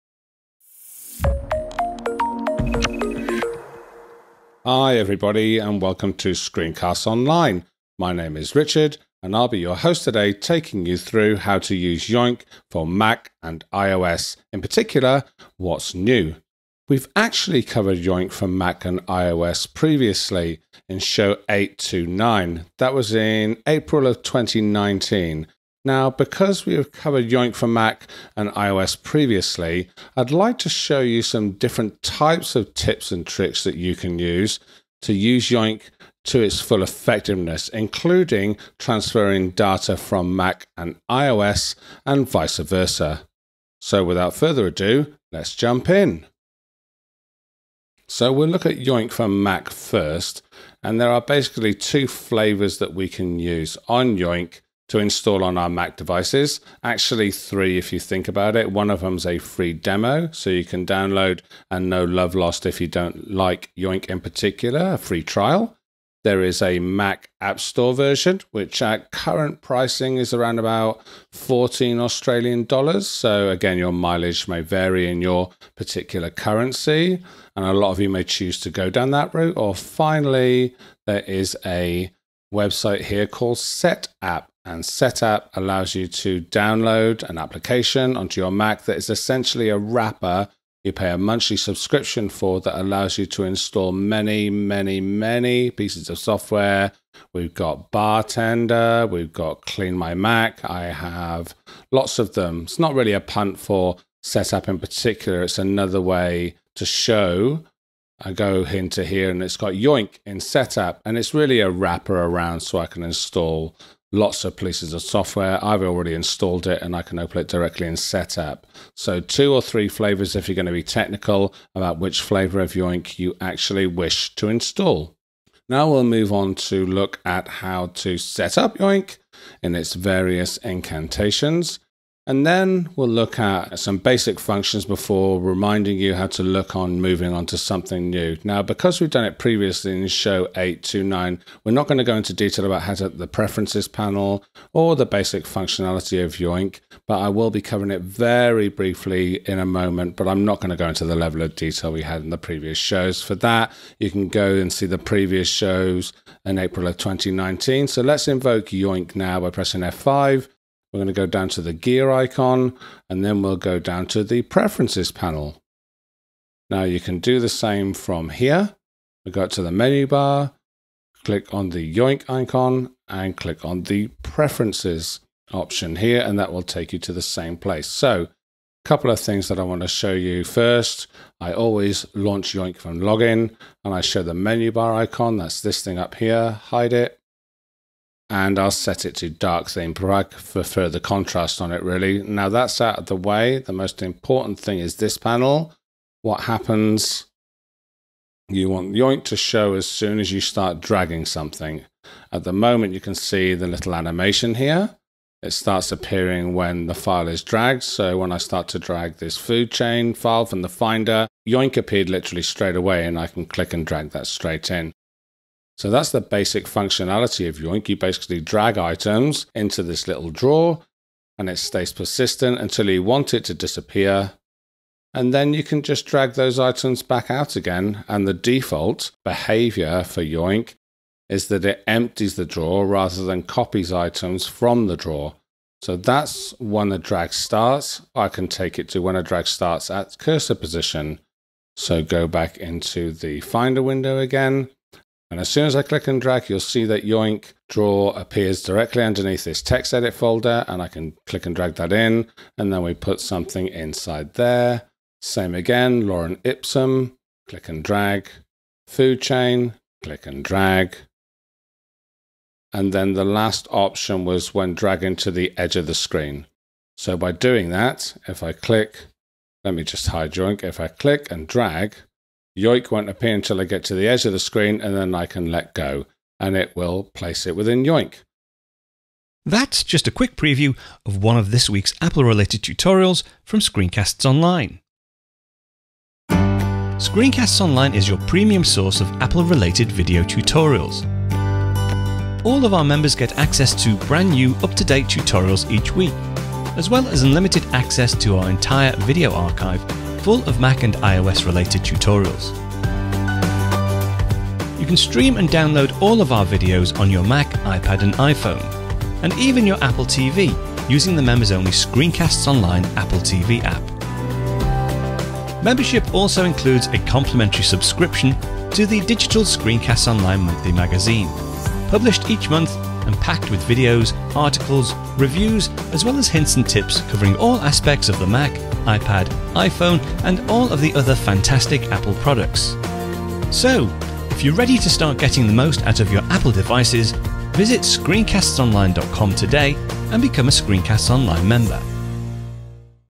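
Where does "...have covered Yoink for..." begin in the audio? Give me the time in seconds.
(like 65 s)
26 s.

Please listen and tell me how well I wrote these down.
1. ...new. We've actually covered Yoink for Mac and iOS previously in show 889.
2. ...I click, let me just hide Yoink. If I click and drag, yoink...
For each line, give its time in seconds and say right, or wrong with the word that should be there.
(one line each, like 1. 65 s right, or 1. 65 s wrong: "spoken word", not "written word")
1. 15 s wrong: "829", not "889"
2. 268 s right.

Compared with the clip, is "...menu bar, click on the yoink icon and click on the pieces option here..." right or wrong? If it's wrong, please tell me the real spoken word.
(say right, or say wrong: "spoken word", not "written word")
wrong: "preferences", not "pieces".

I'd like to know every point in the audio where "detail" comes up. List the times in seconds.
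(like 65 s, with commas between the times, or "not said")
142 s, 151 s.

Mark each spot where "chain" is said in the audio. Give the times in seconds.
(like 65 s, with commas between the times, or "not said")
209 s, 259 s.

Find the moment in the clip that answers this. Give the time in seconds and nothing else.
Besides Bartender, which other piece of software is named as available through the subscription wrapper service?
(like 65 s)
99 s.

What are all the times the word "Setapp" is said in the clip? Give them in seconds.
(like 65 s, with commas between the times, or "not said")
84 s, 104 s, 110 s, 117 s.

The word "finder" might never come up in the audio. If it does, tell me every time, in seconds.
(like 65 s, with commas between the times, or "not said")
210 s, 243 s.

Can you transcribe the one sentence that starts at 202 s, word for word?
At the moment you can see the little animation here.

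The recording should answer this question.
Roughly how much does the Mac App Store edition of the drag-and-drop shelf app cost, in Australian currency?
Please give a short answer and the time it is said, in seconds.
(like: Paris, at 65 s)
14 Australian dollars, at 71 s.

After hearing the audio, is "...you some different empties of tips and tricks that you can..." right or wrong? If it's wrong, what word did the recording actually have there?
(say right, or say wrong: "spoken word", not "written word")
wrong: "types", not "empties".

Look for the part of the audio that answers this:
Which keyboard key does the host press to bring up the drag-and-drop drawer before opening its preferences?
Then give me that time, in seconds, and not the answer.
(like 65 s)
159 s.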